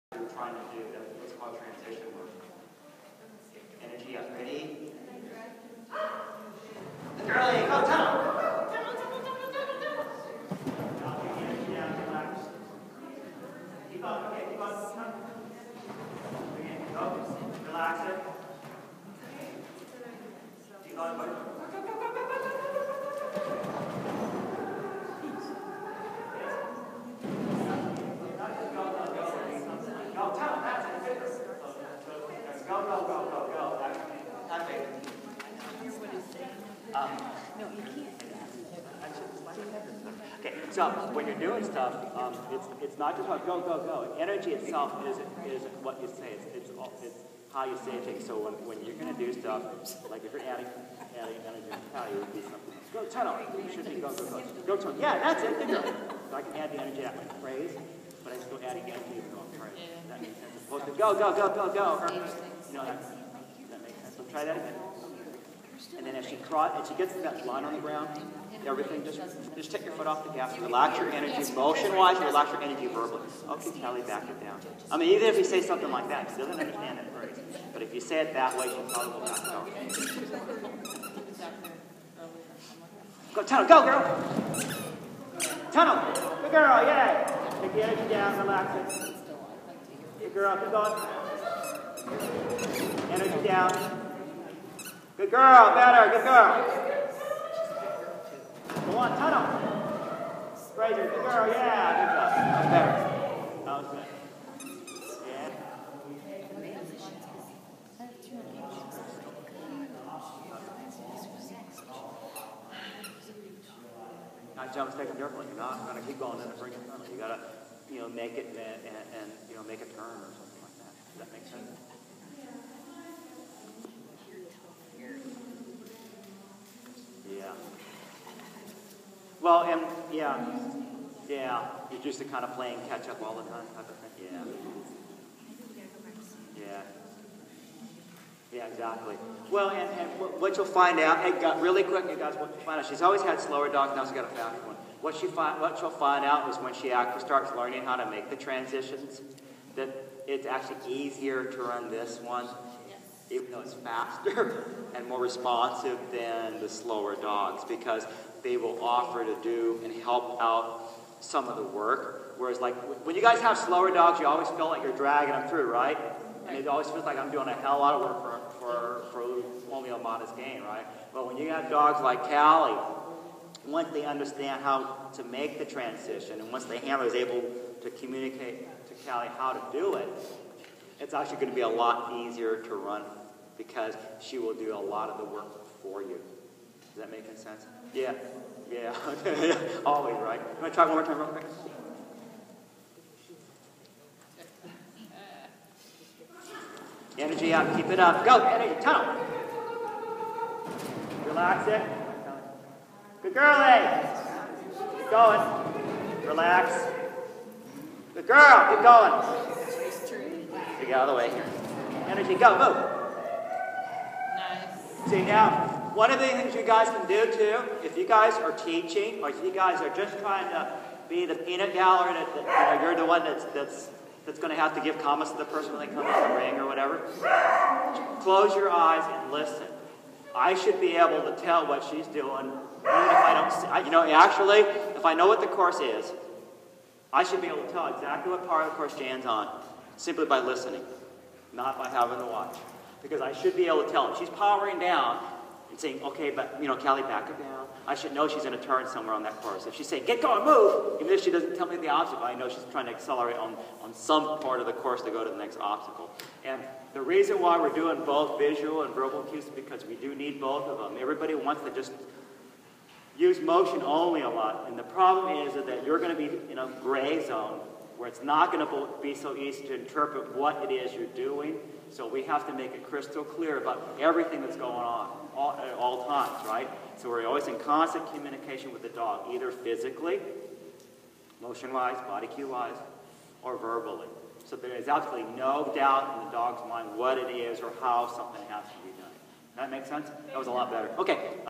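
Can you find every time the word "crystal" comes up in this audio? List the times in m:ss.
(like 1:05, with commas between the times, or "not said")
4:32.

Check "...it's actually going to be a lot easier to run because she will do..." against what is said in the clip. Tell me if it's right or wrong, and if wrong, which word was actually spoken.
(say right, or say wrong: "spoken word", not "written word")
right.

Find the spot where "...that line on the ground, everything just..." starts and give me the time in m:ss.
1:07.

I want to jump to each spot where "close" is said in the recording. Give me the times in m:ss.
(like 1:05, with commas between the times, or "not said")
3:48.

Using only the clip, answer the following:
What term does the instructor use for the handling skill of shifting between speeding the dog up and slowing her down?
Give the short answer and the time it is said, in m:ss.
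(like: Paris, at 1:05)
Transition work, at 0:01.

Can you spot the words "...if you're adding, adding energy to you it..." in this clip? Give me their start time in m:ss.
0:50.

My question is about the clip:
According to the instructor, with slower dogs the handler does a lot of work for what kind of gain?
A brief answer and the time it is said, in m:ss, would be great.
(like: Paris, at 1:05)
A modest gain, at 2:49.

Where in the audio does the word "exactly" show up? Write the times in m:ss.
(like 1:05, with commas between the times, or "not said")
2:18, 3:57.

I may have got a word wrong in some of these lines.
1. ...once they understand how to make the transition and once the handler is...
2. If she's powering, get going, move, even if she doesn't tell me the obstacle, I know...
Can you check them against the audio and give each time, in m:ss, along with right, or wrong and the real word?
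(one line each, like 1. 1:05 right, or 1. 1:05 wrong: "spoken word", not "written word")
1. 2:53 right
2. 4:09 wrong: "saying", not "powering".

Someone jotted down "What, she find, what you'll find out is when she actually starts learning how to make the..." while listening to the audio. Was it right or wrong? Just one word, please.
right.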